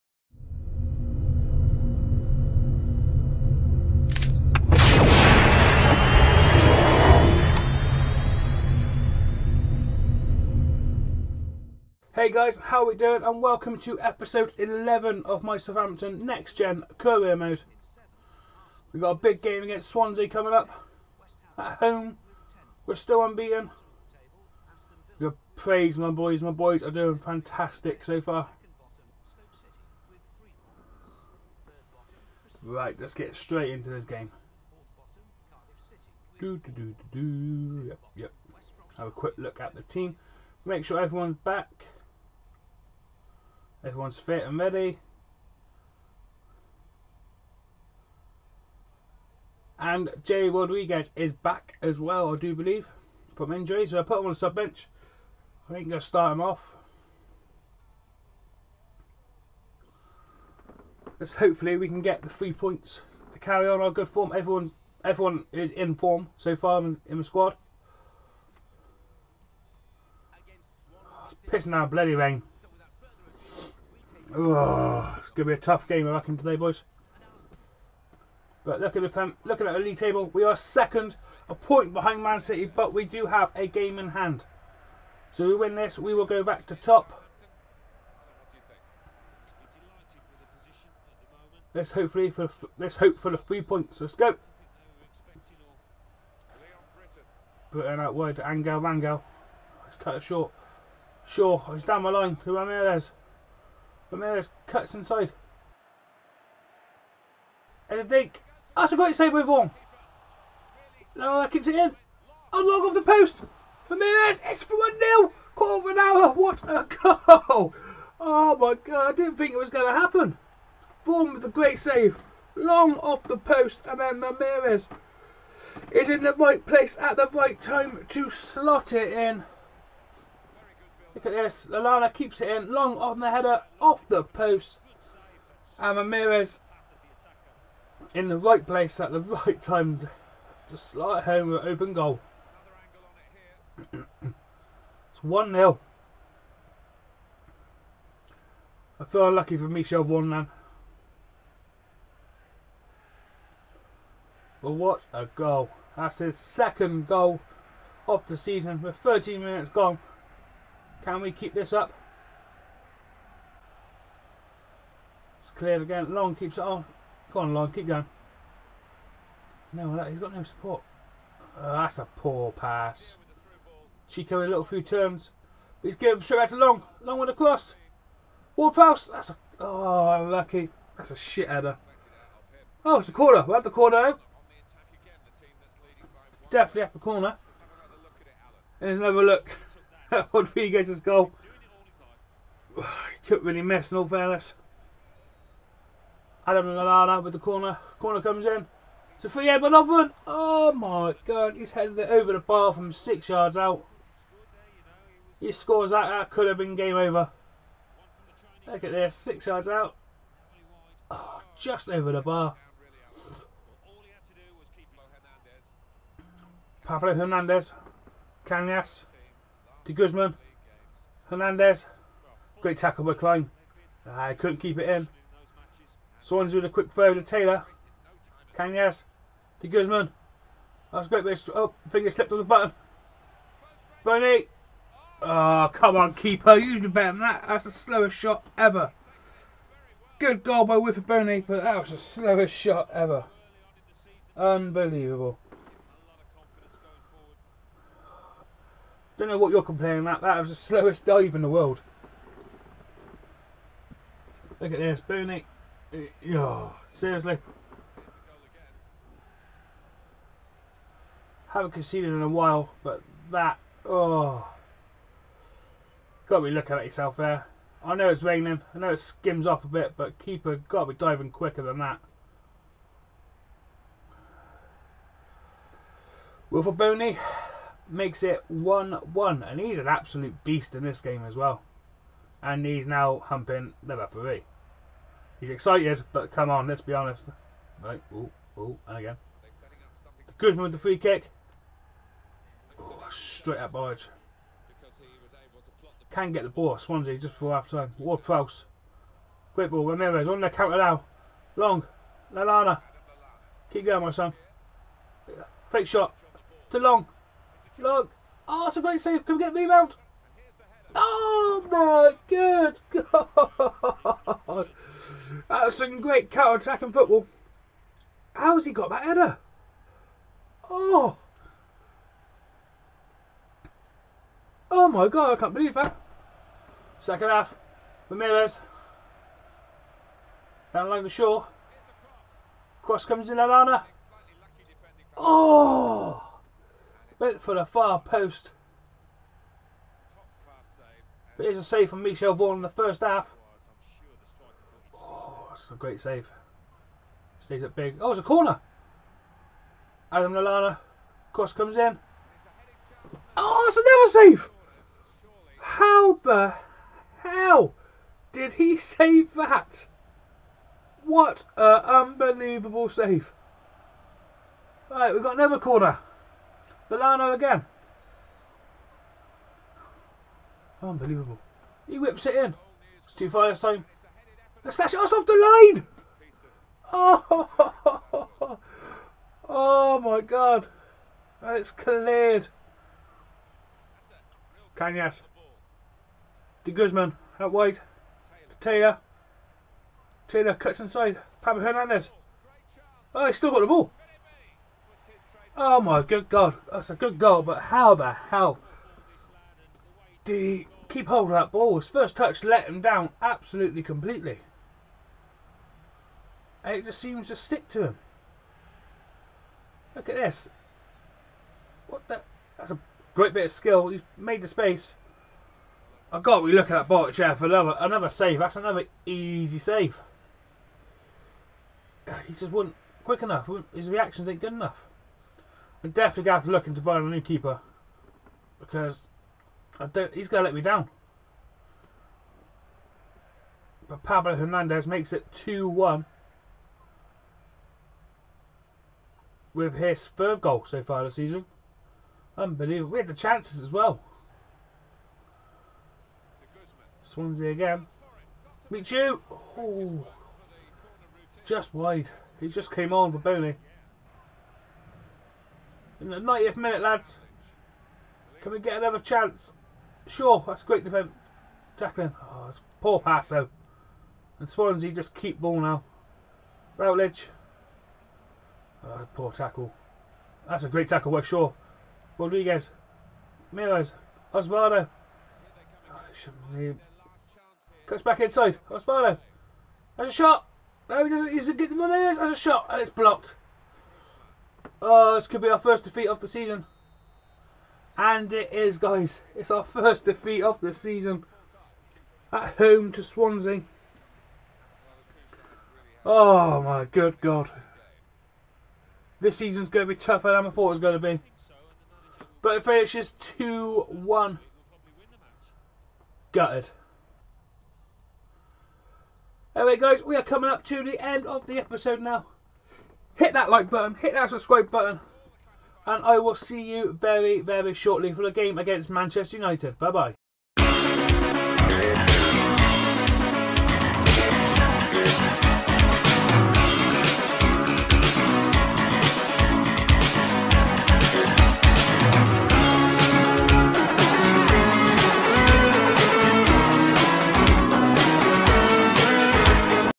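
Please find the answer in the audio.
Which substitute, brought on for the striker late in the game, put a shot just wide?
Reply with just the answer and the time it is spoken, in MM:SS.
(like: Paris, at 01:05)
Michu, at 07:28.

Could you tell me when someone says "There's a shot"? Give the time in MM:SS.
08:01.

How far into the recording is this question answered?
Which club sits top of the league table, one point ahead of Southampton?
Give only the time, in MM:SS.
01:22.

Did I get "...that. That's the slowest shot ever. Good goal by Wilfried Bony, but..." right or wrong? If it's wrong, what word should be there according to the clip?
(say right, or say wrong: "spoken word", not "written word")
right.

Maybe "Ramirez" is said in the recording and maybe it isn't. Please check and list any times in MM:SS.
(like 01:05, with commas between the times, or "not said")
01:42, 01:53, 02:04, 02:15, 04:59, 05:28.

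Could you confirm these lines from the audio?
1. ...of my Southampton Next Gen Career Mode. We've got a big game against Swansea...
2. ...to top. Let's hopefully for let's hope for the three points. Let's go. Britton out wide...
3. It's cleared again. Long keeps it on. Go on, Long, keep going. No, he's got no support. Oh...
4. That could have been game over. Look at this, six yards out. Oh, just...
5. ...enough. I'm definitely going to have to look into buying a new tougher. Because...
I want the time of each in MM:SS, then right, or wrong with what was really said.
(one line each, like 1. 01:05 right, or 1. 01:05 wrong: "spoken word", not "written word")
1. 00:15 right
2. 01:26 right
3. 02:45 right
4. 03:26 right
5. 07:04 wrong: "keeper", not "tougher".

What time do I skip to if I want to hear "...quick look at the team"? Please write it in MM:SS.
00:39.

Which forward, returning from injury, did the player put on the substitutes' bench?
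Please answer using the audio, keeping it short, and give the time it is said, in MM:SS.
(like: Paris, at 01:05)
Jay Rodriguez, at 00:50.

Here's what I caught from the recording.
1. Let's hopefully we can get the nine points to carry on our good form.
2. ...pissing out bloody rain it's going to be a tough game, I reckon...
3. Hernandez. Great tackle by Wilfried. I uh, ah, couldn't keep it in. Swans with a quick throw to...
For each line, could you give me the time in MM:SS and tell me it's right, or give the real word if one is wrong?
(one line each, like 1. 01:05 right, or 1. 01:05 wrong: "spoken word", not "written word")
1. 01:01 wrong: "three", not "nine"
2. 01:11 right
3. 03:41 wrong: "Clyne", not "Wilfried".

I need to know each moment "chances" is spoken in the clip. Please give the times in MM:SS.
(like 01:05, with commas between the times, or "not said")
07:23, 07:38.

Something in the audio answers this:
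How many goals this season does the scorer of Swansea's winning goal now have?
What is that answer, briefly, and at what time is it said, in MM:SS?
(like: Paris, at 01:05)
3, at 07:20.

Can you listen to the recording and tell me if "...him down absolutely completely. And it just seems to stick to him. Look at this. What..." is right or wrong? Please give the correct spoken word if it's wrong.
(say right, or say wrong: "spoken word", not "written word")
right.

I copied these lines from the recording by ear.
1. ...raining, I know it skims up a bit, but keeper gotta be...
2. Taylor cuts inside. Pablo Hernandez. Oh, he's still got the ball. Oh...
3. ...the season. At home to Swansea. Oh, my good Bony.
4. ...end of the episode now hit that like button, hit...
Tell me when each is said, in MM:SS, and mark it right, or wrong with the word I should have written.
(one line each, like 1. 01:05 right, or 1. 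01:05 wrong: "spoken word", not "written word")
1. 04:28 right
2. 06:30 right
3. 08:10 wrong: "God", not "Bony"
4. 08:30 right.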